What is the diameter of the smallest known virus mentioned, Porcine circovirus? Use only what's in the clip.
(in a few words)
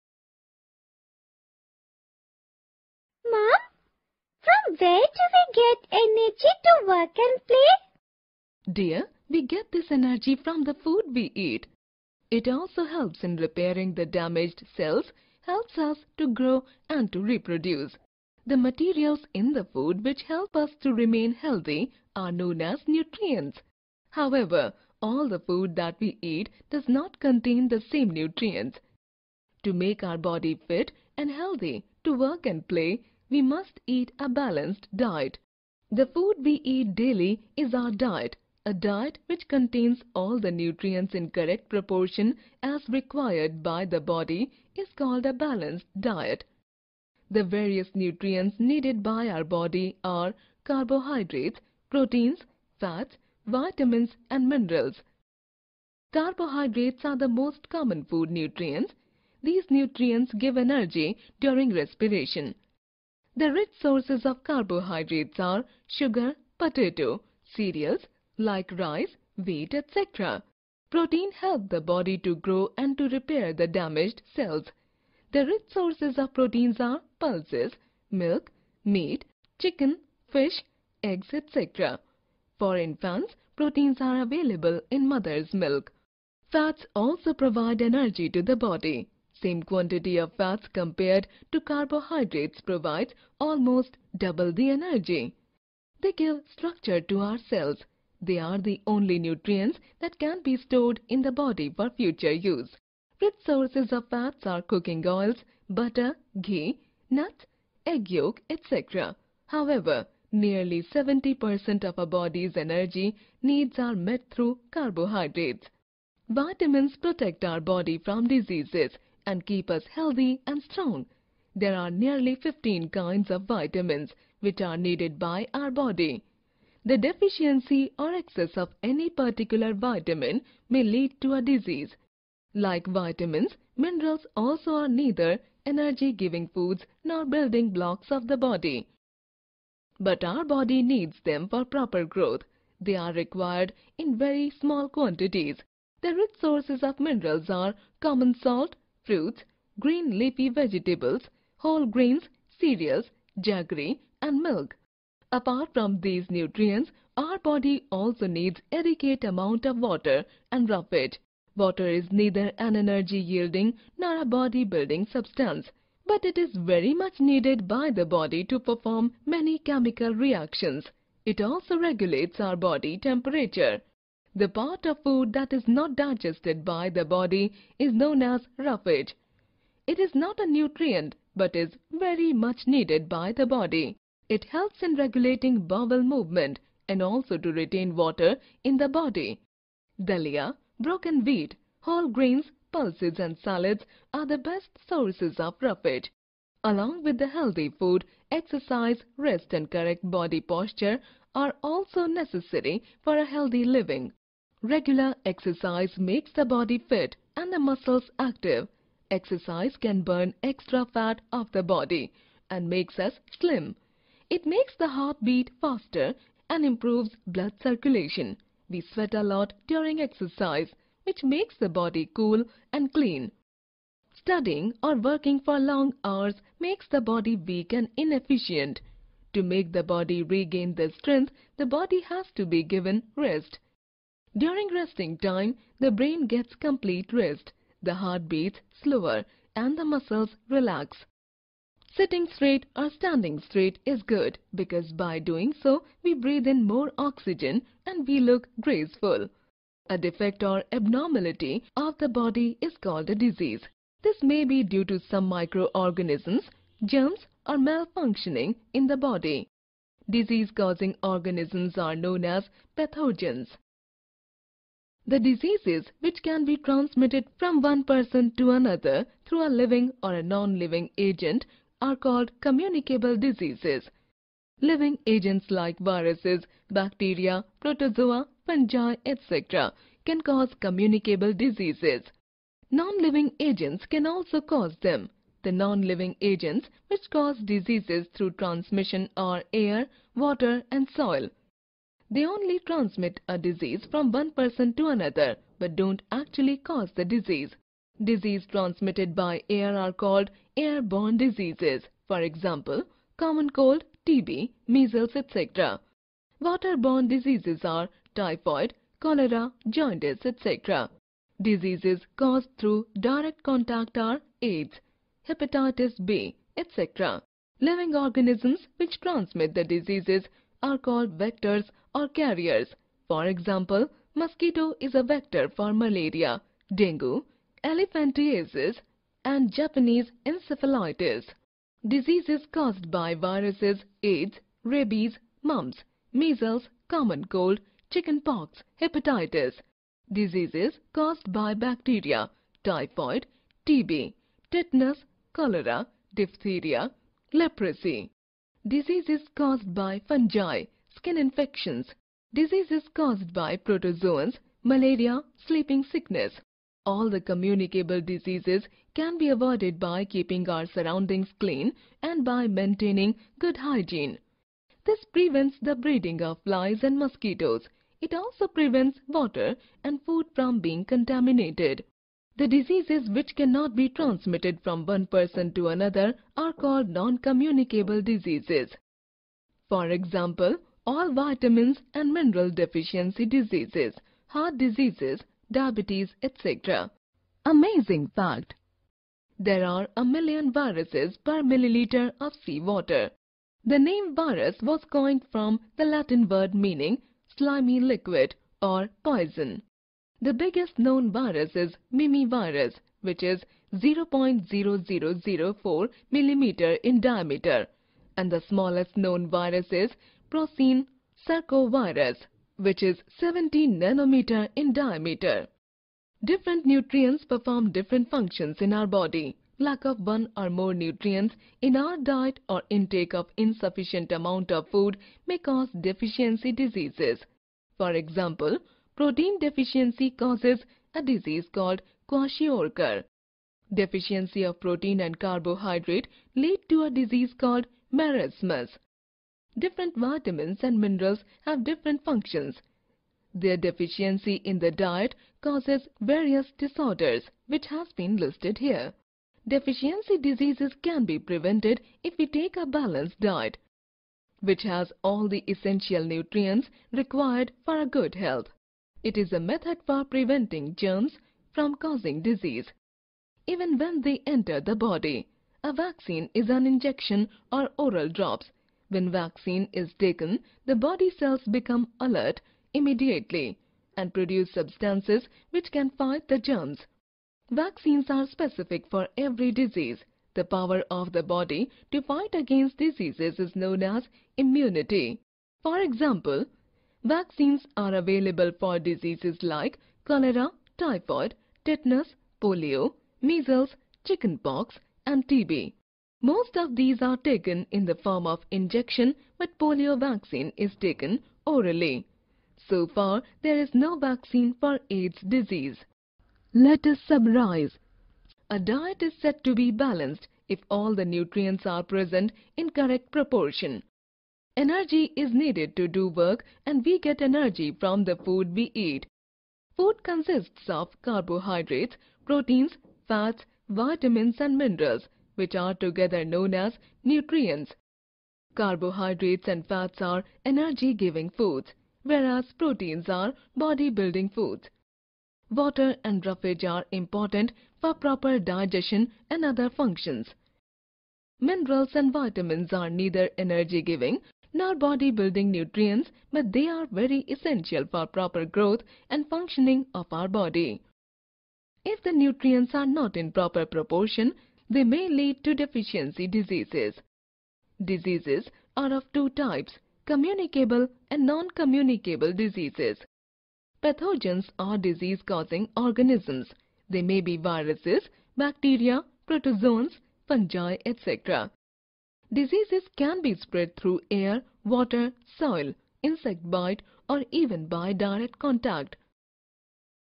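17 nanometers.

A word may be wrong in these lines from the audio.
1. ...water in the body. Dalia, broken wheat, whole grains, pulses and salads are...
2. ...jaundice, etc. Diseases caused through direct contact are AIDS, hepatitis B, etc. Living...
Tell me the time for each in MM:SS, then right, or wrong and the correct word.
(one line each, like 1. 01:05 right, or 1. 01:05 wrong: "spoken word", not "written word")
1. 03:07 right
2. 05:09 right.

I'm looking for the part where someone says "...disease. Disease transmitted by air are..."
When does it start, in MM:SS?
04:57.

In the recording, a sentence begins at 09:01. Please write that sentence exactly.
Minerals and vitamins are neither energy-giving not body-building nutrients but they are very essential for proper growth and functioning of our body.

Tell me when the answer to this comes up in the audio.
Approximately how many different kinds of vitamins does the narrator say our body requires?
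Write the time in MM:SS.
02:02.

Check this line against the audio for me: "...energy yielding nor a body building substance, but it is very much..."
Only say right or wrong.
right.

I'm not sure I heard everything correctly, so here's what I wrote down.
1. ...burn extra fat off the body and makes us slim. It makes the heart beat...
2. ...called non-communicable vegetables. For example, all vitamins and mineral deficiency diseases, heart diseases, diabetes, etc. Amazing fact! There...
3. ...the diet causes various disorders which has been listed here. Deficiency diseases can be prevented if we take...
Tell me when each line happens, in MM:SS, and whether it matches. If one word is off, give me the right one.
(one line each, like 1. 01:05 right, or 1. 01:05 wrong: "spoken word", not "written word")
1. 03:30 right
2. 06:16 wrong: "diseases", not "vegetables"
3. 07:24 right.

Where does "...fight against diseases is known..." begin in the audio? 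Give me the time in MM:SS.
08:02.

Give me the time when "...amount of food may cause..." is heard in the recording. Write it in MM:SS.
07:04.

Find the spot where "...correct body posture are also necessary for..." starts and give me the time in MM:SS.
03:19.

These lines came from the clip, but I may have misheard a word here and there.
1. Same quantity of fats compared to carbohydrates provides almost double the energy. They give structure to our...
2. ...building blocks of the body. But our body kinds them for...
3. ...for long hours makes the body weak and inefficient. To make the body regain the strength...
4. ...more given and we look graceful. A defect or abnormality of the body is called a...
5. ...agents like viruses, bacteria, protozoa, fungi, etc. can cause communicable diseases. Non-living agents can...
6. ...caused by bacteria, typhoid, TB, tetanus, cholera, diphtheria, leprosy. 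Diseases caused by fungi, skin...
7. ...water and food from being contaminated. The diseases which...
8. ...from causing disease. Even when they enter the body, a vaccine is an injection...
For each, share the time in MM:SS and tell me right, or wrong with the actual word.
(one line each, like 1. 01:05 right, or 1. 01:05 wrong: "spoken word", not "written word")
1. 01:29 right
2. 02:17 wrong: "needs", not "kinds"
3. 03:45 right
4. 04:06 wrong: "oxygen", not "given"
5. 04:35 right
6. 05:40 right
7. 06:09 right
8. 07:41 right.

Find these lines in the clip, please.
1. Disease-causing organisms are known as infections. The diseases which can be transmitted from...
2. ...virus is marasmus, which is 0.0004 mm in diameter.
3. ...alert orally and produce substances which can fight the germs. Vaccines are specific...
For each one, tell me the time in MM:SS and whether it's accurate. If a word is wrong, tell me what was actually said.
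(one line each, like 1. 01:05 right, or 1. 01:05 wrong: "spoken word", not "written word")
1. 04:20 wrong: "pathogens", not "infections"
2. 06:41 wrong: "mimivirus", not "marasmus"
3. 07:51 wrong: "immediately", not "orally".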